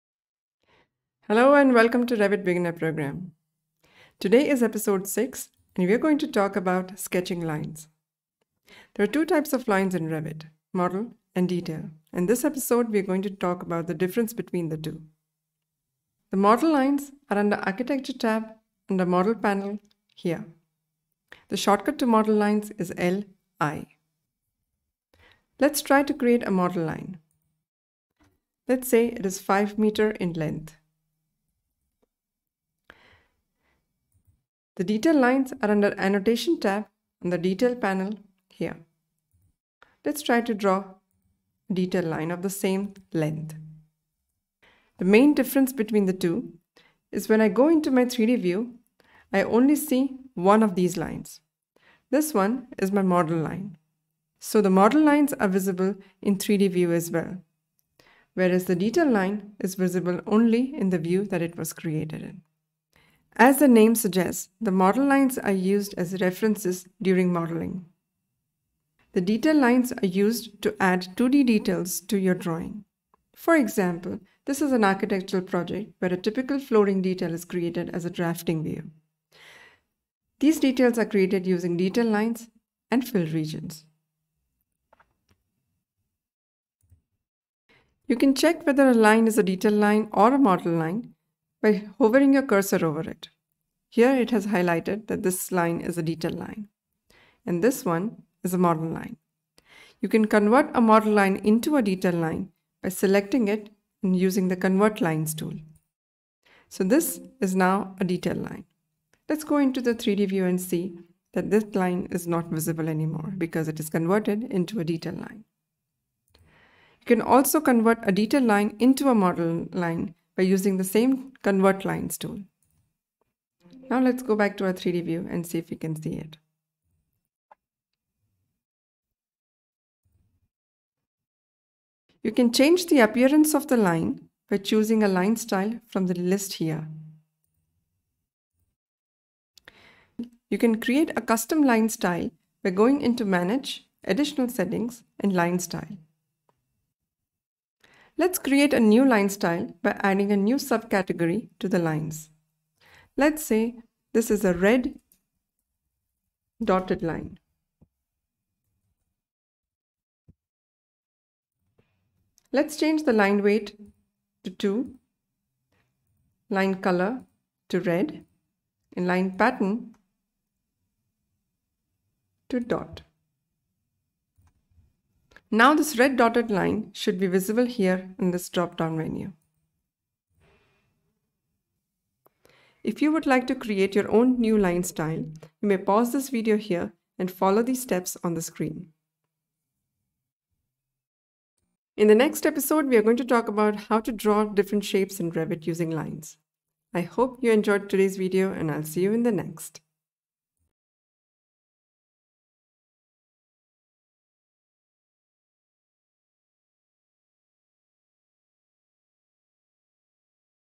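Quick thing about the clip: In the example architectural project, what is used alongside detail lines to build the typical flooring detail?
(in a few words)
fill regions.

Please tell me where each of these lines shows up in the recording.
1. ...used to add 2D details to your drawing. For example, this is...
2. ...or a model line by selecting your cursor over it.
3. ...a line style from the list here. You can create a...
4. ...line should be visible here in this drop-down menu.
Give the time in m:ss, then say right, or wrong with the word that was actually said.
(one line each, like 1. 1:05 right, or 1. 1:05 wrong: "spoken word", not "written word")
1. 1:10 right
2. 1:30 wrong: "hovering", not "selecting"
3. 2:15 right
4. 2:56 right.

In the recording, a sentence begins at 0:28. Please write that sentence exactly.
Let's say it is 5 meter in length.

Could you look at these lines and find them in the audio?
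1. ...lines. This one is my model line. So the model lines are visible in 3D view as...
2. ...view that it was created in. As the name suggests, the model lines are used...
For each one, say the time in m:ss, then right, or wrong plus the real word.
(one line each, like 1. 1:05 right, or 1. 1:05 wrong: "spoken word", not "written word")
1. 0:50 right
2. 1:00 right.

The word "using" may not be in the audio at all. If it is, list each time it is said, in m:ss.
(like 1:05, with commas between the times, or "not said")
1:21, 1:44, 2:00, 3:15.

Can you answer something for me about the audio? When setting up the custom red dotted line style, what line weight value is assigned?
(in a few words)
2.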